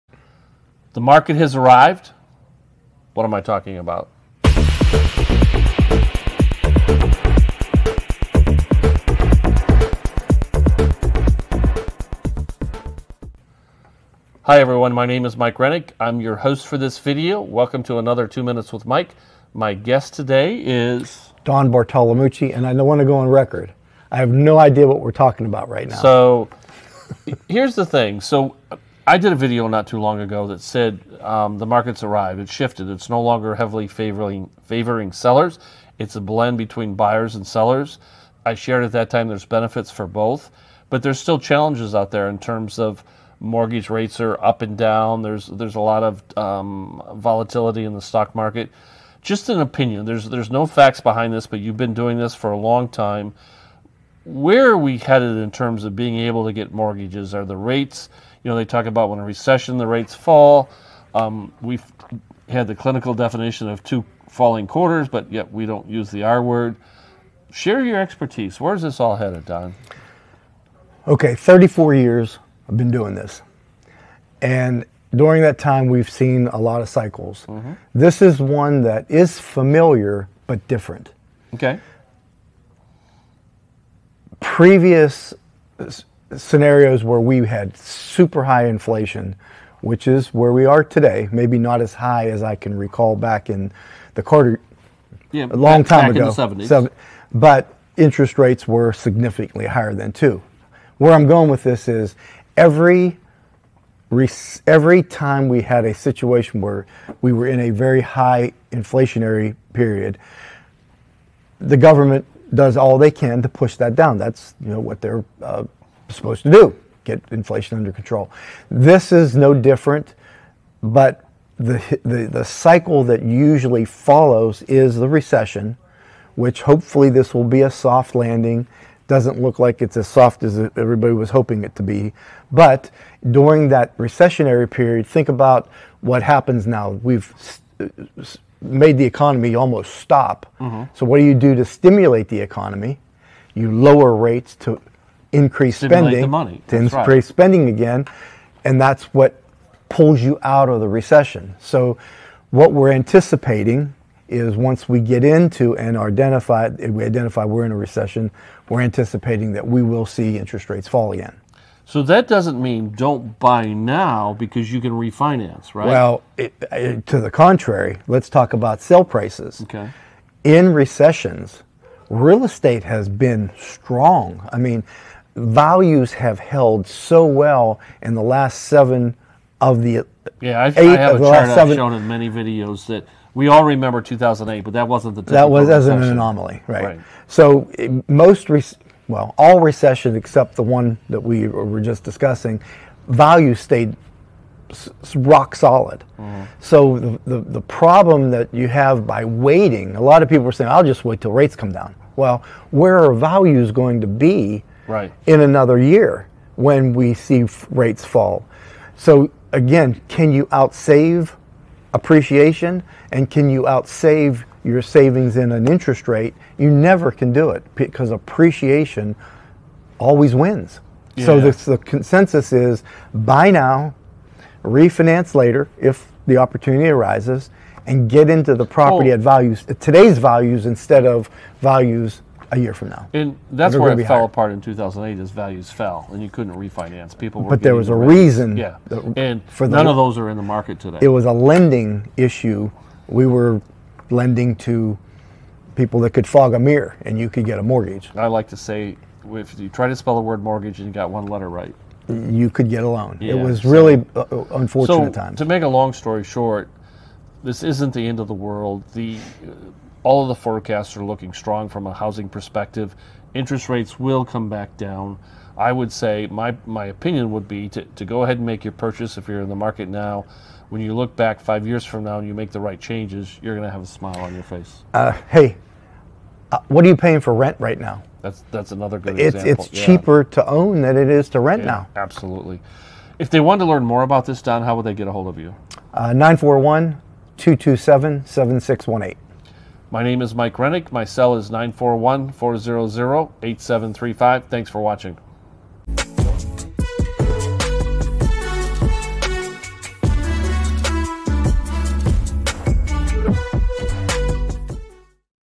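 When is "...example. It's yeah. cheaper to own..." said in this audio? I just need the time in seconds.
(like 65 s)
279 s.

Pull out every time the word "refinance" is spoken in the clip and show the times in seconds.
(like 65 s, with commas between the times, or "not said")
164 s, 224 s, 236 s.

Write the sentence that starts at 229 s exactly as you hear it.
at values today's values instead of values a year from now.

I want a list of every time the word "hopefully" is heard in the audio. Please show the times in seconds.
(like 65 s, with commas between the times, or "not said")
126 s.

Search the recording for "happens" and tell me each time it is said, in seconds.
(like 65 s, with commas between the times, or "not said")
136 s.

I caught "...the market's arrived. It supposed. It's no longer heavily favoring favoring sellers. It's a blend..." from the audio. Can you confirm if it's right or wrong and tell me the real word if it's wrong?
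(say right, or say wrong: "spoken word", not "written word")
wrong: "shifted", not "supposed".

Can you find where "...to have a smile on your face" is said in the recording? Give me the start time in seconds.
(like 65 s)
273 s.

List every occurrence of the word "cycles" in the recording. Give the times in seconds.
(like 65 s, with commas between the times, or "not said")
76 s, 122 s.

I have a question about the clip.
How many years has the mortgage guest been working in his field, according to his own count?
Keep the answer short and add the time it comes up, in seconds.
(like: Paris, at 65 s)
34, at 71 s.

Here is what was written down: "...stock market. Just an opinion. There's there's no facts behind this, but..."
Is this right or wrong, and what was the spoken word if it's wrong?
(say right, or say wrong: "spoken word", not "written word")
right.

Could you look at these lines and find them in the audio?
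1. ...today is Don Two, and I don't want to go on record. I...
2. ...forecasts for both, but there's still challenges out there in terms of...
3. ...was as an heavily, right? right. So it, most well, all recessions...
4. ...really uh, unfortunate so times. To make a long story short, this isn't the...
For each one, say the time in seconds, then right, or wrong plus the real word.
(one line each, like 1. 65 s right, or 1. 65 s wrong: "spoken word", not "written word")
1. 20 s wrong: "Bartolomucci", not "Two"
2. 39 s wrong: "benefits", not "forecasts"
3. 185 s wrong: "anomaly", not "heavily"
4. 253 s right.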